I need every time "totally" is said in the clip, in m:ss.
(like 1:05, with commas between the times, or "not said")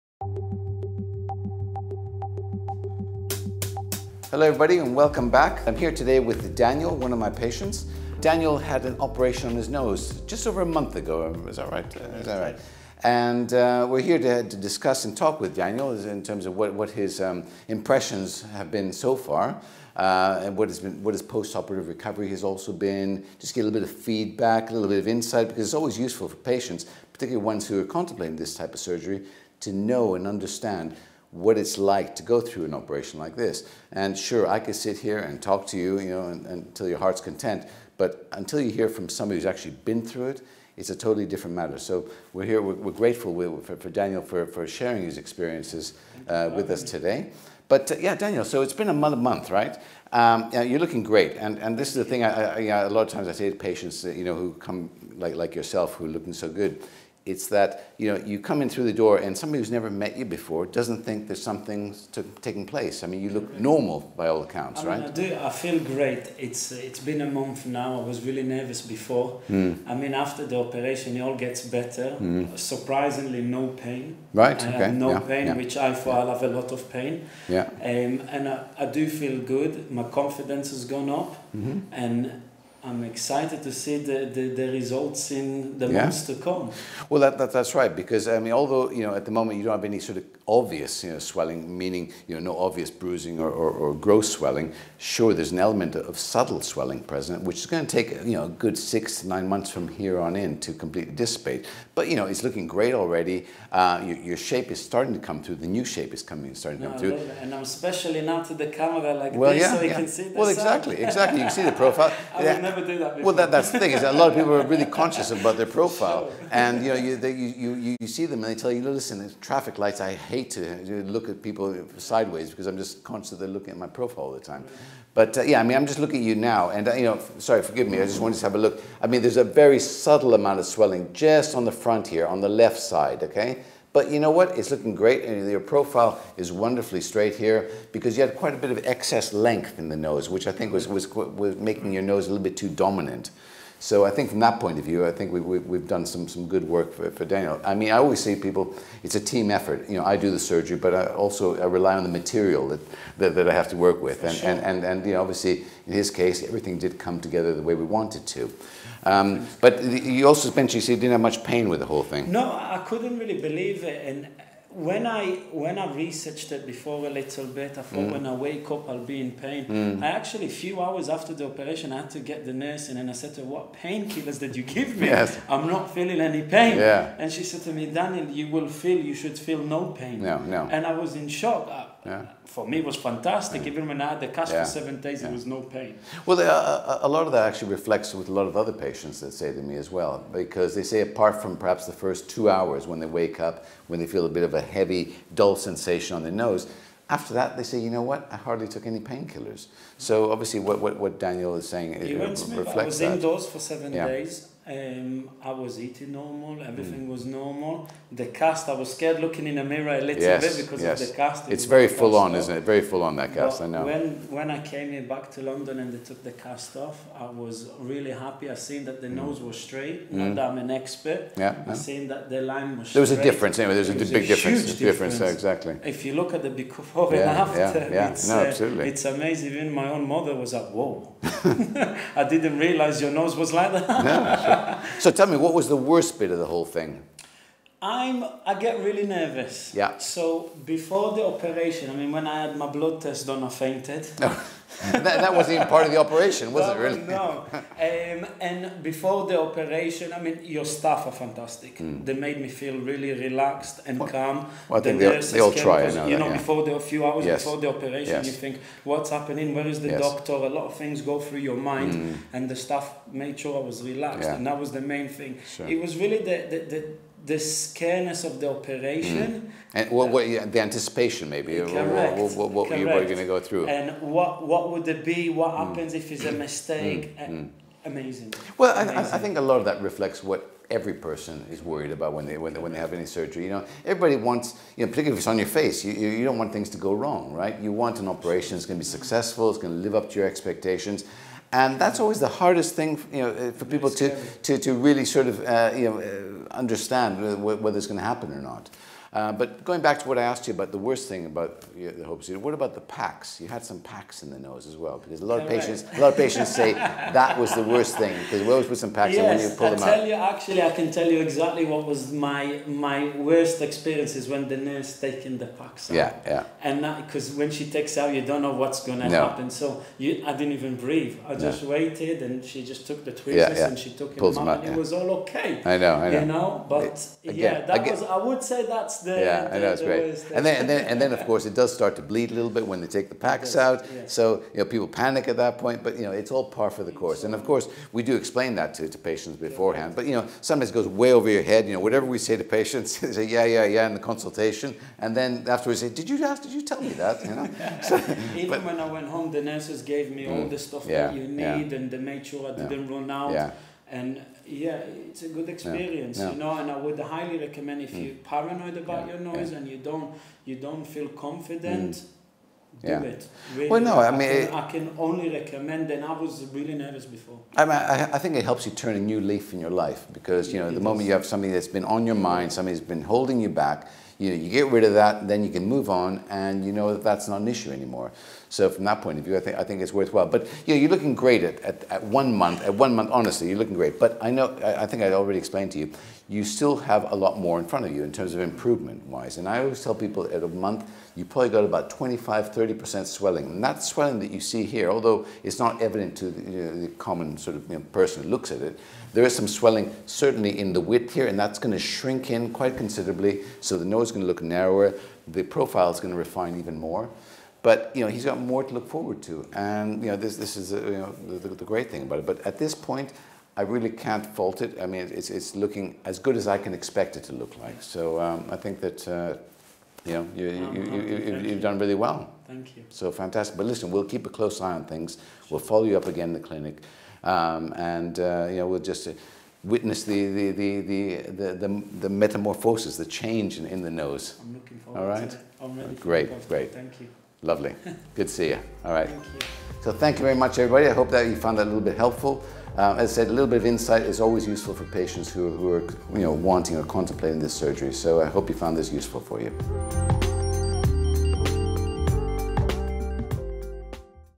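0:40.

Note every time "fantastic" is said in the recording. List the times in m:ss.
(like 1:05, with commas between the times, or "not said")
3:02, 4:11, 7:03.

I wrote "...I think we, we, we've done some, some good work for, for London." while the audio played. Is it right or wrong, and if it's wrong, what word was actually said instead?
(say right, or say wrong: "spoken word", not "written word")
wrong: "Daniel", not "London".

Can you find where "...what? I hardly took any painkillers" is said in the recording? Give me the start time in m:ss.
3:18.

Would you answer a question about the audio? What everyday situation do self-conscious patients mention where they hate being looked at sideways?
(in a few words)
traffic lights.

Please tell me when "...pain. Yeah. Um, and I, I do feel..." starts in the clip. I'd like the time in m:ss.
1:16.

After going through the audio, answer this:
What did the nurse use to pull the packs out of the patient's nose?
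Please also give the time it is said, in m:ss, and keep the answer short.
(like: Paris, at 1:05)
tweezers, at 5:23.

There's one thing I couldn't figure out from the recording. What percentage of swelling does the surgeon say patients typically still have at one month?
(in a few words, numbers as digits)
25 to 30%.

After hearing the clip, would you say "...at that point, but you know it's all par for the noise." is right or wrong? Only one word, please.
wrong.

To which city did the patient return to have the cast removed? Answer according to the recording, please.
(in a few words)
London.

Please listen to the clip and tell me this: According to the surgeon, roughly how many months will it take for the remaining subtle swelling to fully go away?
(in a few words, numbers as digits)
6 to 9 months.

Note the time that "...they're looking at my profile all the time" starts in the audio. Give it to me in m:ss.
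2:03.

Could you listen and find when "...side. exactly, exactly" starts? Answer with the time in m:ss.
1:50.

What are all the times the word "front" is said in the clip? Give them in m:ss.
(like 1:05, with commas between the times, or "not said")
2:11, 6:27.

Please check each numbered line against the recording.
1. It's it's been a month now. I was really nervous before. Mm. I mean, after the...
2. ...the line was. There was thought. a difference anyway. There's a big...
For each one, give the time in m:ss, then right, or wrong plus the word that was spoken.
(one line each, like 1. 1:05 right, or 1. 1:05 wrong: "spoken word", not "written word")
1. 1:06 right
2. 3:42 wrong: "straight", not "thought".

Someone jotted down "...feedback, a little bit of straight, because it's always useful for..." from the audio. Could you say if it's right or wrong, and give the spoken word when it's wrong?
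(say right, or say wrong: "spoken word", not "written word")
wrong: "insight", not "straight".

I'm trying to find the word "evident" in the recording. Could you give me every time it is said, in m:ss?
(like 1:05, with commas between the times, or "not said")
6:35.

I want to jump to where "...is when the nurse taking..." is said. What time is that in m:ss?
5:14.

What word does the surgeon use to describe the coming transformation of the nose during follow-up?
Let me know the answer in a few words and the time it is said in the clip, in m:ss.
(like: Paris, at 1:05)
metamorphosis, at 7:12.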